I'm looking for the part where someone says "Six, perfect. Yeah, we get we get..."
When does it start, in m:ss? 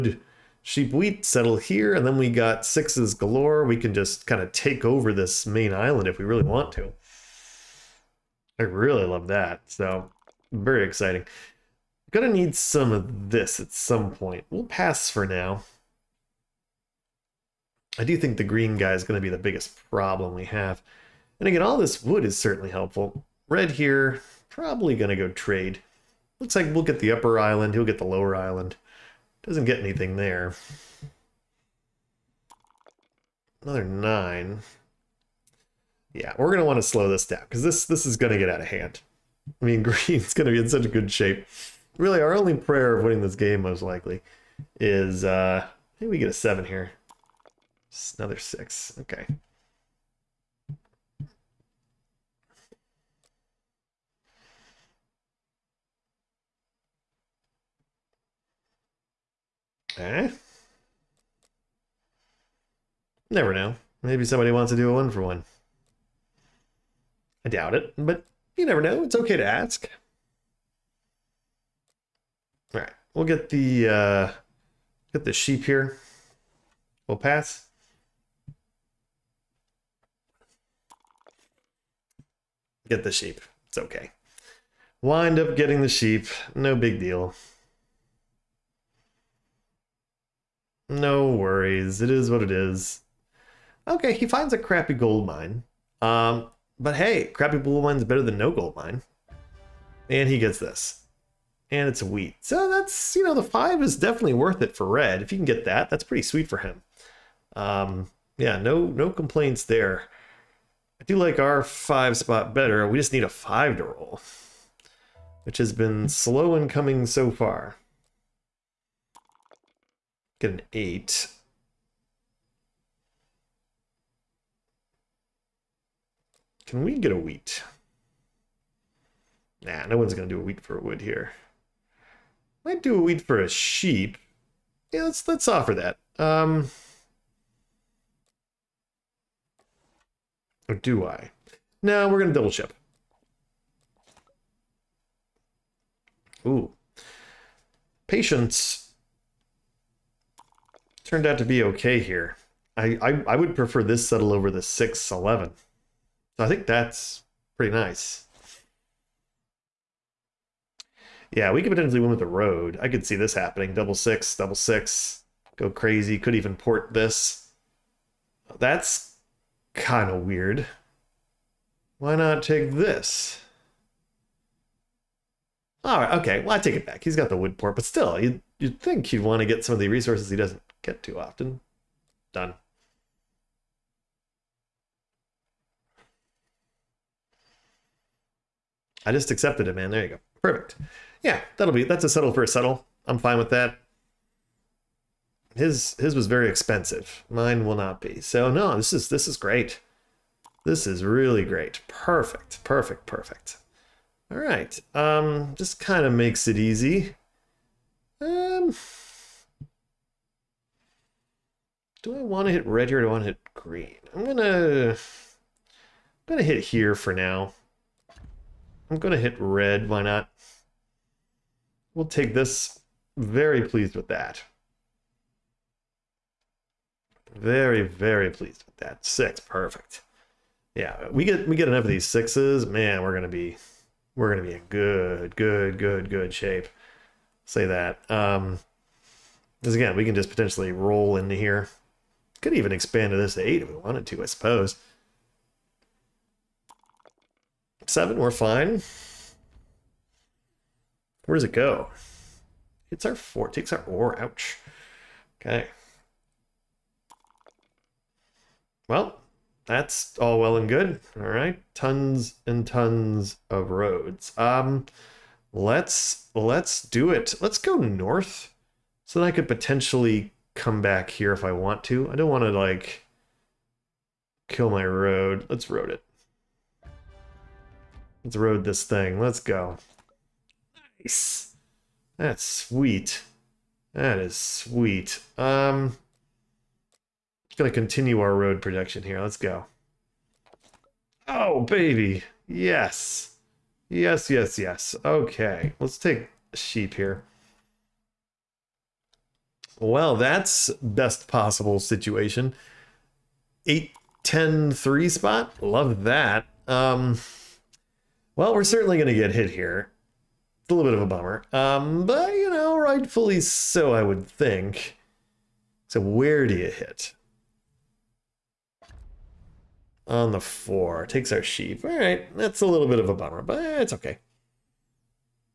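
3:49.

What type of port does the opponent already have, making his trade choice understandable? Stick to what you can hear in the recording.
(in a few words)
wood port.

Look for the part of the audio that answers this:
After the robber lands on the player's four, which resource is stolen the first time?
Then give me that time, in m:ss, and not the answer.
4:13.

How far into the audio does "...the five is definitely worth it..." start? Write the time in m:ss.
1:43.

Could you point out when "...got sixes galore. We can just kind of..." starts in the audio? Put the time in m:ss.
0:02.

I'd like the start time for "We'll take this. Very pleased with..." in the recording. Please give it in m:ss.
3:41.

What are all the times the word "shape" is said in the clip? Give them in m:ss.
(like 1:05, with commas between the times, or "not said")
0:41, 3:56.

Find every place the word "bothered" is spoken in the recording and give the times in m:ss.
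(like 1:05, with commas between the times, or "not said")
not said.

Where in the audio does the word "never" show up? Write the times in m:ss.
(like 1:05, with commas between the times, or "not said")
1:03, 1:08.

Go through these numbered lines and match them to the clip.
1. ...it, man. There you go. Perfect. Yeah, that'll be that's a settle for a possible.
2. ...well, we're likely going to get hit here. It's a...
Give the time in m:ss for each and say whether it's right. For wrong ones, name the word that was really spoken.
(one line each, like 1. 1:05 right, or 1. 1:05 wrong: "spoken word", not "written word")
1. 3:09 wrong: "settle", not "possible"
2. 5:08 wrong: "certainly", not "likely".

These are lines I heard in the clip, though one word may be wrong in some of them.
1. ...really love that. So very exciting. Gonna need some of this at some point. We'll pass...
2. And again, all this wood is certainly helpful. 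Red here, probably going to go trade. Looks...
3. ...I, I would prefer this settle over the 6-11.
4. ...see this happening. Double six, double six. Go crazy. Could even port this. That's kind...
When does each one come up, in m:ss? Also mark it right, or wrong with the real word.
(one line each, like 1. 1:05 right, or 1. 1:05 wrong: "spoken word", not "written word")
1. 0:08 right
2. 0:21 right
3. 2:33 right
4. 2:43 right.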